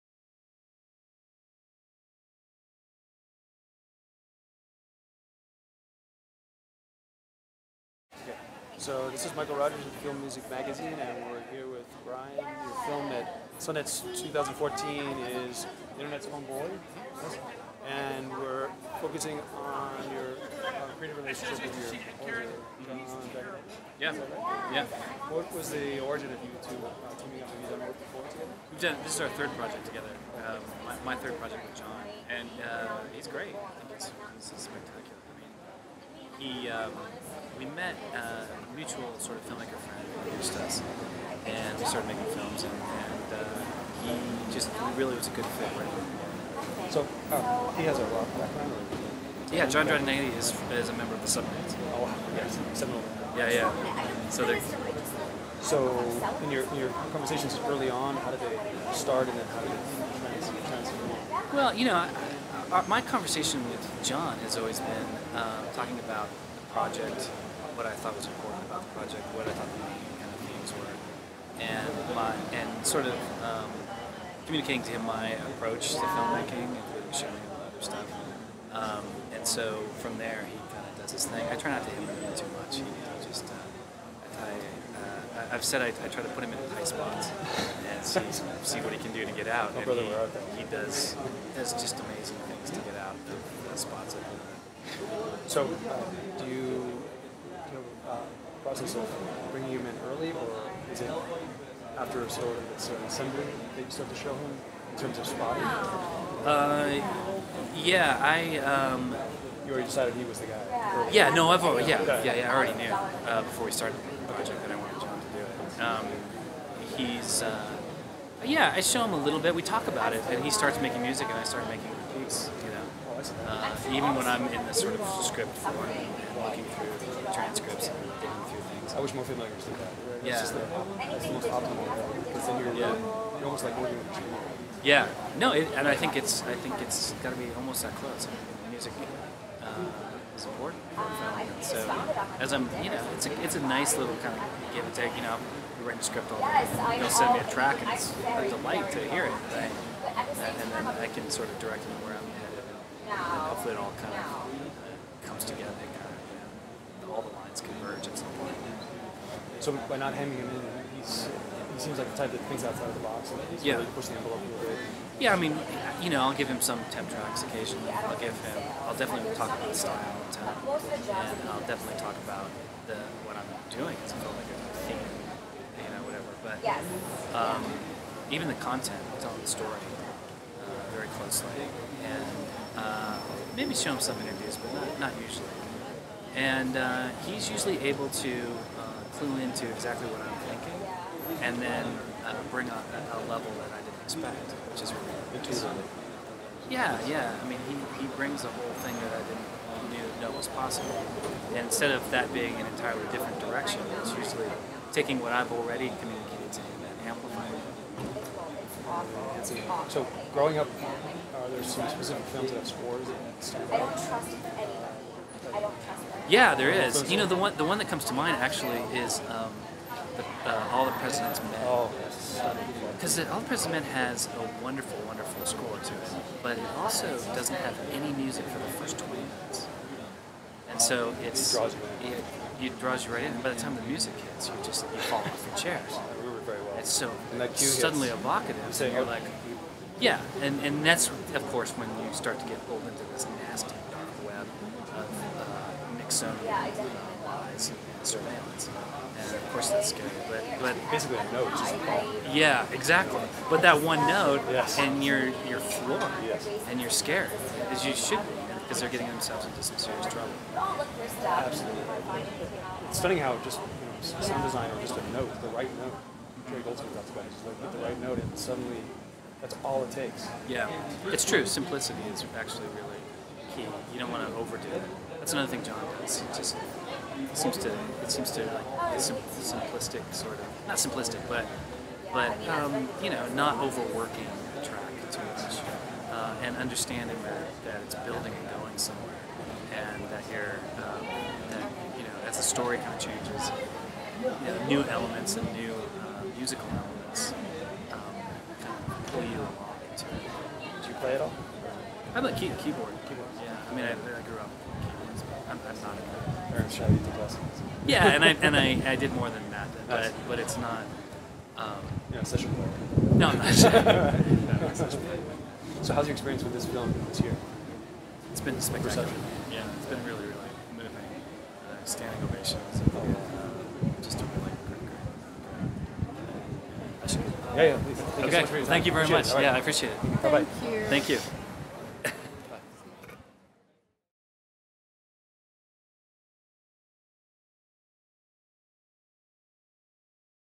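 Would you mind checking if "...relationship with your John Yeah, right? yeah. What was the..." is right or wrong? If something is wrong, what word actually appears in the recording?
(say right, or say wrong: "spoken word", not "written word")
right.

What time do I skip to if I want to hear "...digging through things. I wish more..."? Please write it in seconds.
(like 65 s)
128 s.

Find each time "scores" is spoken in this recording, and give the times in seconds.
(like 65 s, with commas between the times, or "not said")
212 s, 225 s.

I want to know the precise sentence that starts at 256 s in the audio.
and you're scared, as you should be, because they're getting themselves into some serious trouble.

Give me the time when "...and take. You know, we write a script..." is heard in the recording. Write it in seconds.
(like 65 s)
144 s.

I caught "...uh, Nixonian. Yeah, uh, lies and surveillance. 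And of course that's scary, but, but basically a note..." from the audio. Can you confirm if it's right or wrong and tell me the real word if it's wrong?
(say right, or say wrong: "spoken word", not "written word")
right.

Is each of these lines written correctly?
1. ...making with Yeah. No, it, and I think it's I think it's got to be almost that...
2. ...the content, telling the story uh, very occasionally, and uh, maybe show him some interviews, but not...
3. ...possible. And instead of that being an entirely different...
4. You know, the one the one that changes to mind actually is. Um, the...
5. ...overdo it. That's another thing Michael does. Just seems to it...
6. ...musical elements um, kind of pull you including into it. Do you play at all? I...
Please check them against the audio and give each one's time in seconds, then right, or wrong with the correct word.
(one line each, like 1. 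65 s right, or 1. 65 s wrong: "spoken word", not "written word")
1. 133 s wrong: "working", not "making"
2. 178 s wrong: "closely", not "occasionally"
3. 200 s right
4. 217 s wrong: "comes", not "changes"
5. 274 s wrong: "John", not "Michael"
6. 296 s wrong: "along", not "including".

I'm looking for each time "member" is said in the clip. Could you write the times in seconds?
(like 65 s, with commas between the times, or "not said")
50 s.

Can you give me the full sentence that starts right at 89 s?
Oh, and brother, he, he does does just amazing things to get out of the spots.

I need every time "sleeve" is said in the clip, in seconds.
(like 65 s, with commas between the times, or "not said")
not said.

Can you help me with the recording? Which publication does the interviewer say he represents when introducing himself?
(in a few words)
Film Music Magazine.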